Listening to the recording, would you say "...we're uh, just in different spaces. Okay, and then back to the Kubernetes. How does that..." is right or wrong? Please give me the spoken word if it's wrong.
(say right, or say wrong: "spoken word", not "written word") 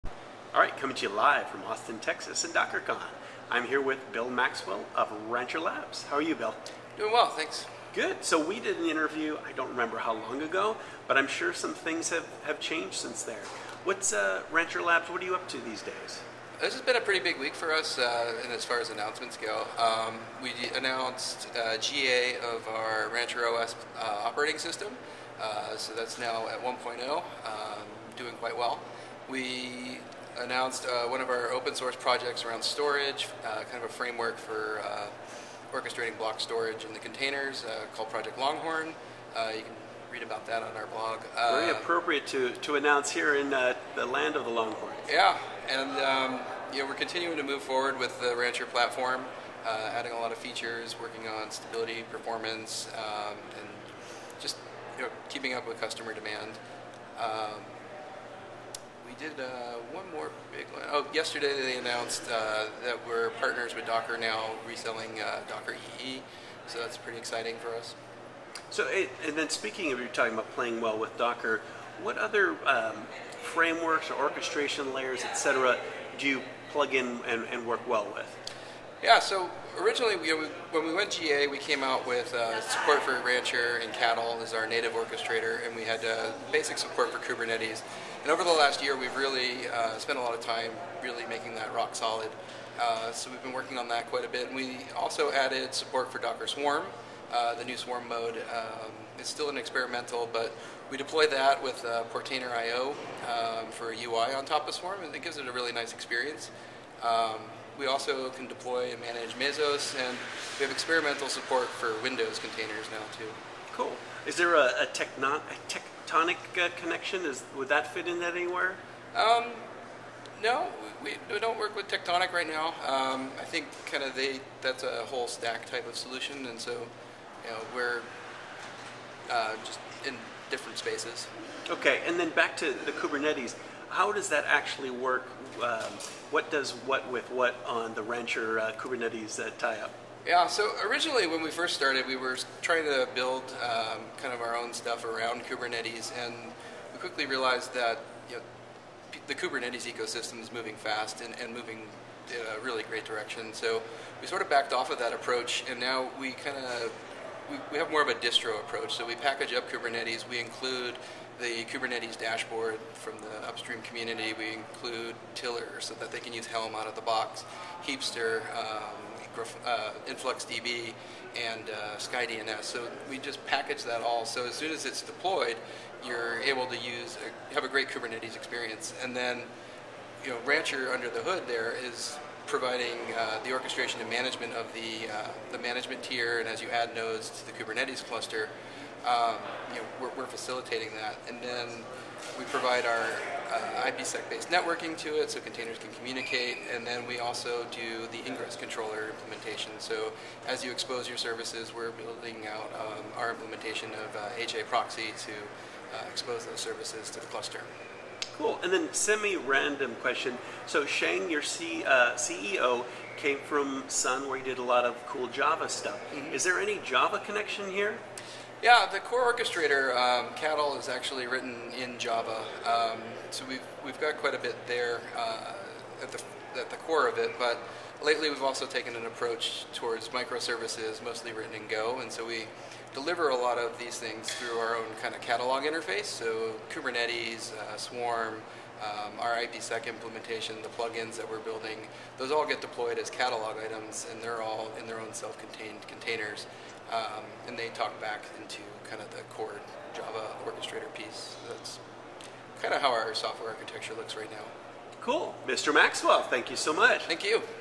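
right.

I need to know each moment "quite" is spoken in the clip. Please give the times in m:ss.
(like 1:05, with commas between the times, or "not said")
0:28, 1:34, 3:44.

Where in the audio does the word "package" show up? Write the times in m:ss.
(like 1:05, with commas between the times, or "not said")
2:39, 2:53.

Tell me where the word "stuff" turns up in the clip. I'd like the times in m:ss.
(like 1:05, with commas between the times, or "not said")
2:24, 3:35.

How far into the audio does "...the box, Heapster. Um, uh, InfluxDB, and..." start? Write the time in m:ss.
2:46.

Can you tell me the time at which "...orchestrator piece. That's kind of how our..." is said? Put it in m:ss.
4:10.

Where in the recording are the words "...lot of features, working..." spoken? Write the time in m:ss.
0:50.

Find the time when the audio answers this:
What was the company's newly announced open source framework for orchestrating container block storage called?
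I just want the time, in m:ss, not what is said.
0:38.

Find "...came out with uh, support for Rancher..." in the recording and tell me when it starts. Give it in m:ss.
1:21.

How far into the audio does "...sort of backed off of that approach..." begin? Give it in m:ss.
2:34.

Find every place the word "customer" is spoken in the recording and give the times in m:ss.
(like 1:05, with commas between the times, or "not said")
0:55.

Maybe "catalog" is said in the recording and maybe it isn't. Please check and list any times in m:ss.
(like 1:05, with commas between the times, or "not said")
3:55, 4:03.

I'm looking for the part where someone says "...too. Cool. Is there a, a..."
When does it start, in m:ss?
1:53.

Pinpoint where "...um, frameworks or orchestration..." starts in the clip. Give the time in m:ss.
1:12.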